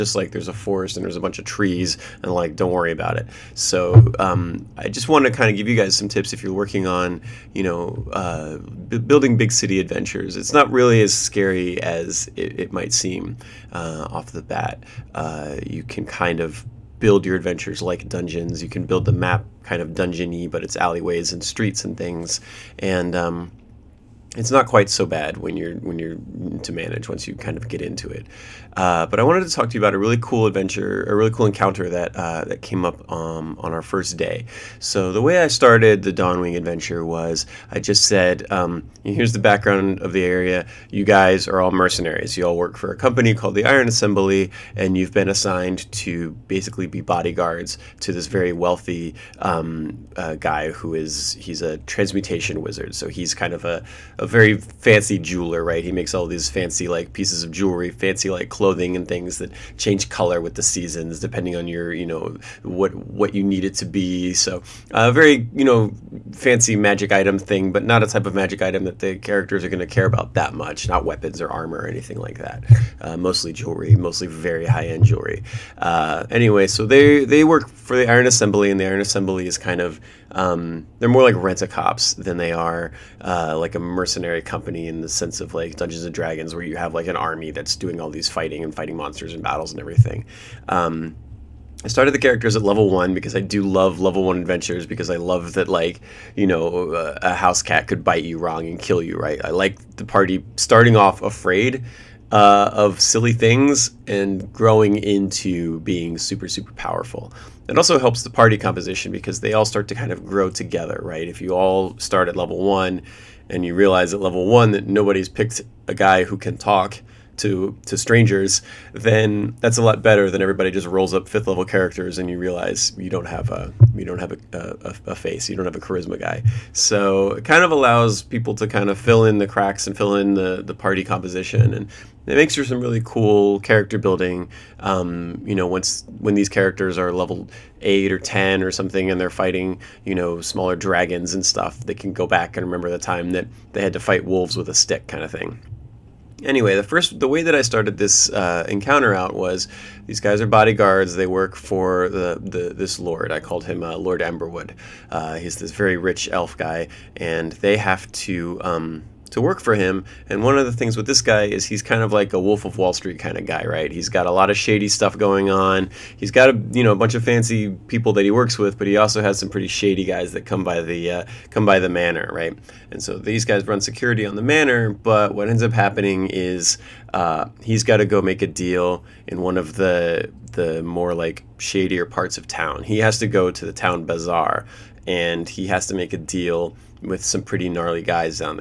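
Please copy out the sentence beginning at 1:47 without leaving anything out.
It also helps the party composition because they all start to kind of grow together, right?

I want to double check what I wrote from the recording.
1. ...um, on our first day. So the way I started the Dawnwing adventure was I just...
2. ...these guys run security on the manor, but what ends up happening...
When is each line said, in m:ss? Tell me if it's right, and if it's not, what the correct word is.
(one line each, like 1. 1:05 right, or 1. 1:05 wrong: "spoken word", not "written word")
1. 0:33 right
2. 2:53 right.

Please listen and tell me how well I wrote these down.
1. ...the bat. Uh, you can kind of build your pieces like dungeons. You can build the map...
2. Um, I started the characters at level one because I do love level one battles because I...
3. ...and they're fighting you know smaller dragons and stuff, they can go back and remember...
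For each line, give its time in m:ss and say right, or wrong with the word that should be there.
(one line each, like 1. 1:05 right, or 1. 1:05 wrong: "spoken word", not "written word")
1. 0:14 wrong: "adventures", not "pieces"
2. 1:30 wrong: "adventures", not "battles"
3. 2:19 right.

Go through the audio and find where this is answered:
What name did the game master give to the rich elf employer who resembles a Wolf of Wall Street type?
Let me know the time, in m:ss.
2:33.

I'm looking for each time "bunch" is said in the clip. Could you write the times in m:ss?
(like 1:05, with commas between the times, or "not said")
0:01, 2:46.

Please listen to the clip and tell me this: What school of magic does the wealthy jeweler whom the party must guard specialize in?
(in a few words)
Transmutation.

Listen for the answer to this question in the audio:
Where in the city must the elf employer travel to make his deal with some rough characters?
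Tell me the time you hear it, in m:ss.
3:03.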